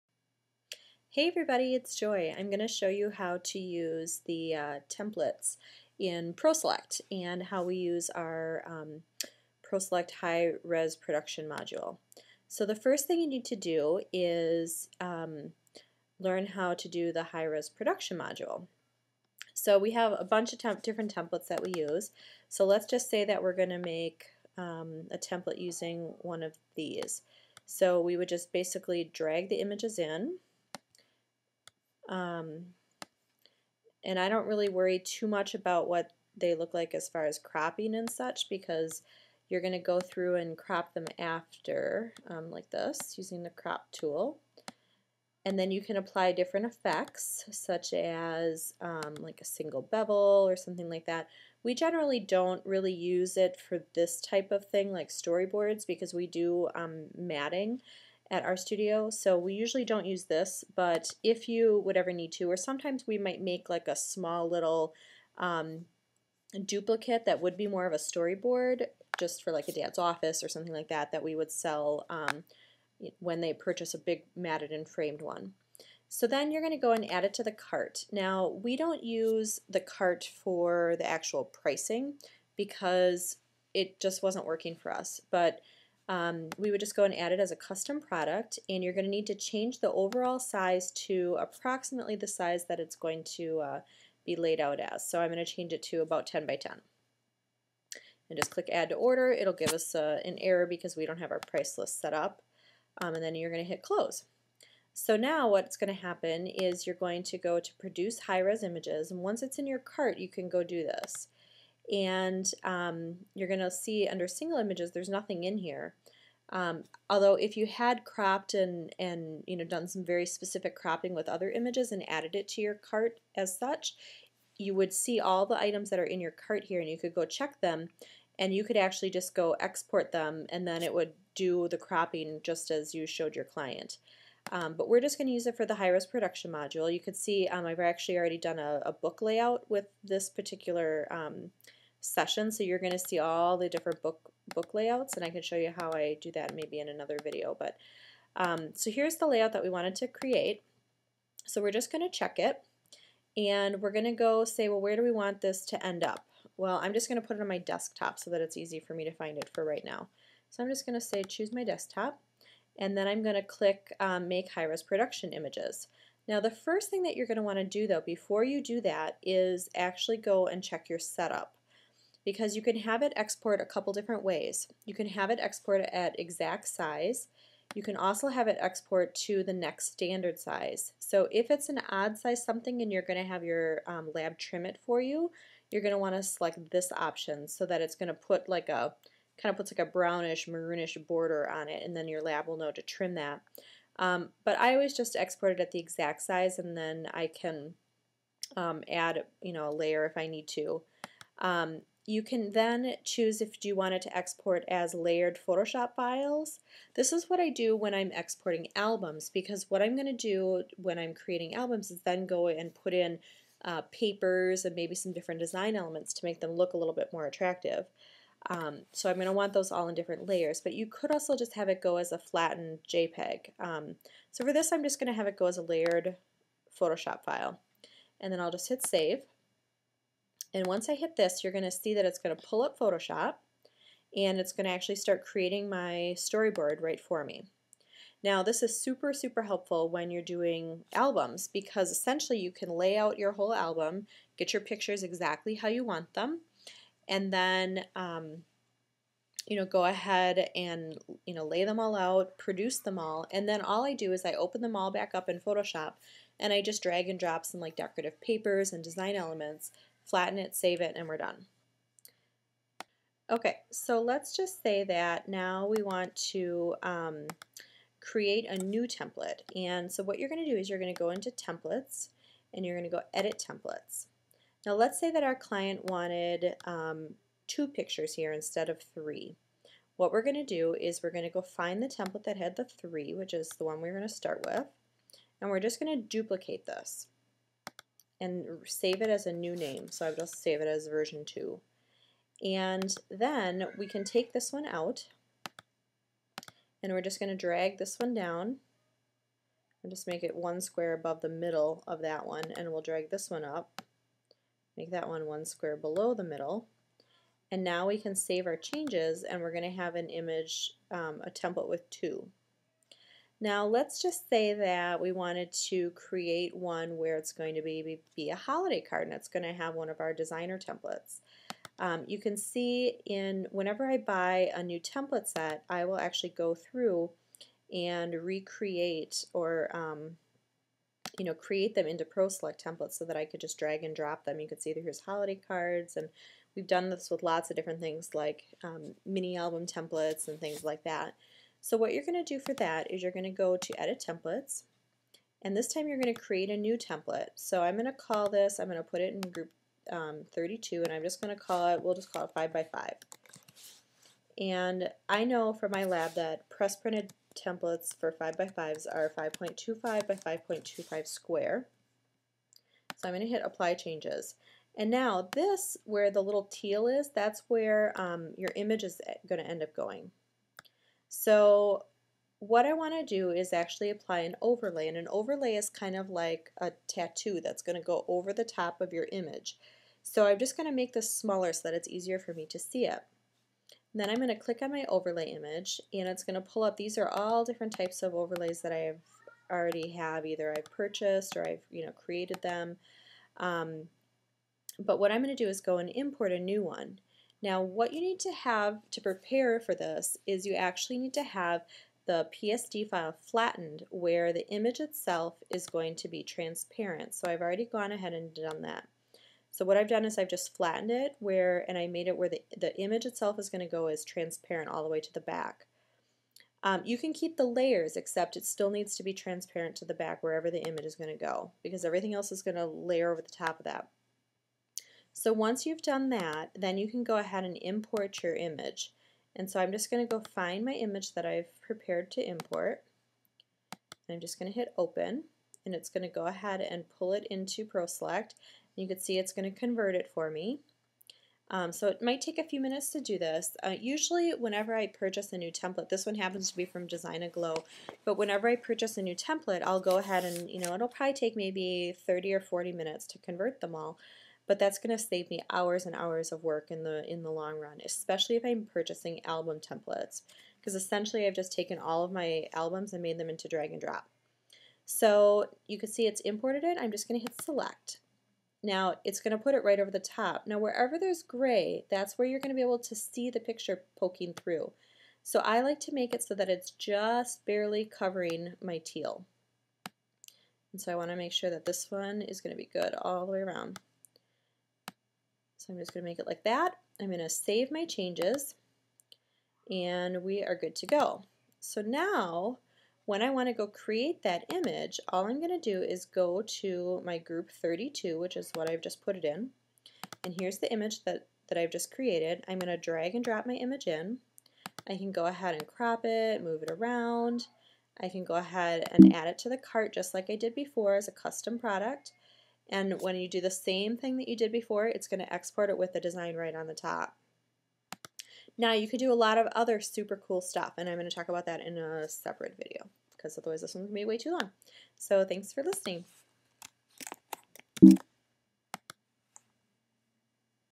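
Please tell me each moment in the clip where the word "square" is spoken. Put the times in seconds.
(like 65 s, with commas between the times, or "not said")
300 s, 305 s, 361 s.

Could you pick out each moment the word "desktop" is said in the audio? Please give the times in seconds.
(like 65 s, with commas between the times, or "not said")
157 s, 161 s.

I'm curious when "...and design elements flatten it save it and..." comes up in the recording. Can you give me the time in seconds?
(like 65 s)
258 s.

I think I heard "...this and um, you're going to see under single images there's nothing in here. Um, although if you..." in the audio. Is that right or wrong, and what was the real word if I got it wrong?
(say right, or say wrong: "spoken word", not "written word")
right.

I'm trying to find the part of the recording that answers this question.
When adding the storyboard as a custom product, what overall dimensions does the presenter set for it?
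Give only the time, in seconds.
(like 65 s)
96 s.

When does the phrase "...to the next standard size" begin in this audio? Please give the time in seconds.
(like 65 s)
179 s.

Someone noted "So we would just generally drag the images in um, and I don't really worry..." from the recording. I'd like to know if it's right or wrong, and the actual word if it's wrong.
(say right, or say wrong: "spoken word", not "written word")
wrong: "basically", not "generally".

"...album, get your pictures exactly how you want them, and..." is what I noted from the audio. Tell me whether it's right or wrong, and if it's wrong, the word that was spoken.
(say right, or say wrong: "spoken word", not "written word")
right.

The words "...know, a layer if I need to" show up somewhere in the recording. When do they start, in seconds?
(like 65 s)
199 s.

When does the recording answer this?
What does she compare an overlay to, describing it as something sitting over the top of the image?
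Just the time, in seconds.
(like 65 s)
376 s.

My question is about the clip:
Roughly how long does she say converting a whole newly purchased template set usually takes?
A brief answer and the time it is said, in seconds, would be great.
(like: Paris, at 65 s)
30 or 40 minutes, at 452 s.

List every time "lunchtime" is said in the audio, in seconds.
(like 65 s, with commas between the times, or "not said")
not said.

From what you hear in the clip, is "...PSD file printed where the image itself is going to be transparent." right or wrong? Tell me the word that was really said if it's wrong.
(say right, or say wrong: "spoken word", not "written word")
wrong: "flattened", not "printed".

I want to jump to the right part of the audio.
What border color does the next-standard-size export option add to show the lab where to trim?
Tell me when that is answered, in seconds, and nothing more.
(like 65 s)
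189 s.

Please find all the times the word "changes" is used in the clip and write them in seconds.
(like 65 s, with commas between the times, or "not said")
89 s, 95 s, 308 s, 363 s, 487 s.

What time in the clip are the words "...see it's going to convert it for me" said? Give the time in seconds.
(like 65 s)
438 s.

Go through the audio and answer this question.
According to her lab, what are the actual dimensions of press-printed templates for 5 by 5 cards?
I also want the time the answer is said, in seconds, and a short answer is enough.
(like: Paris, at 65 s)
5.25 by 5.25, at 359 s.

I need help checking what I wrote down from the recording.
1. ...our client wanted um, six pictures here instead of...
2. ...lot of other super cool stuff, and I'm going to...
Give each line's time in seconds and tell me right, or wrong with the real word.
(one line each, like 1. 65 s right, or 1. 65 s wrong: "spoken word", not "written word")
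1. 275 s wrong: "two", not "six"
2. 519 s right.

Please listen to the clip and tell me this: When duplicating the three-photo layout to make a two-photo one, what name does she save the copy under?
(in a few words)
version 2.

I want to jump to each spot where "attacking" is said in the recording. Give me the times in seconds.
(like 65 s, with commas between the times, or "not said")
not said.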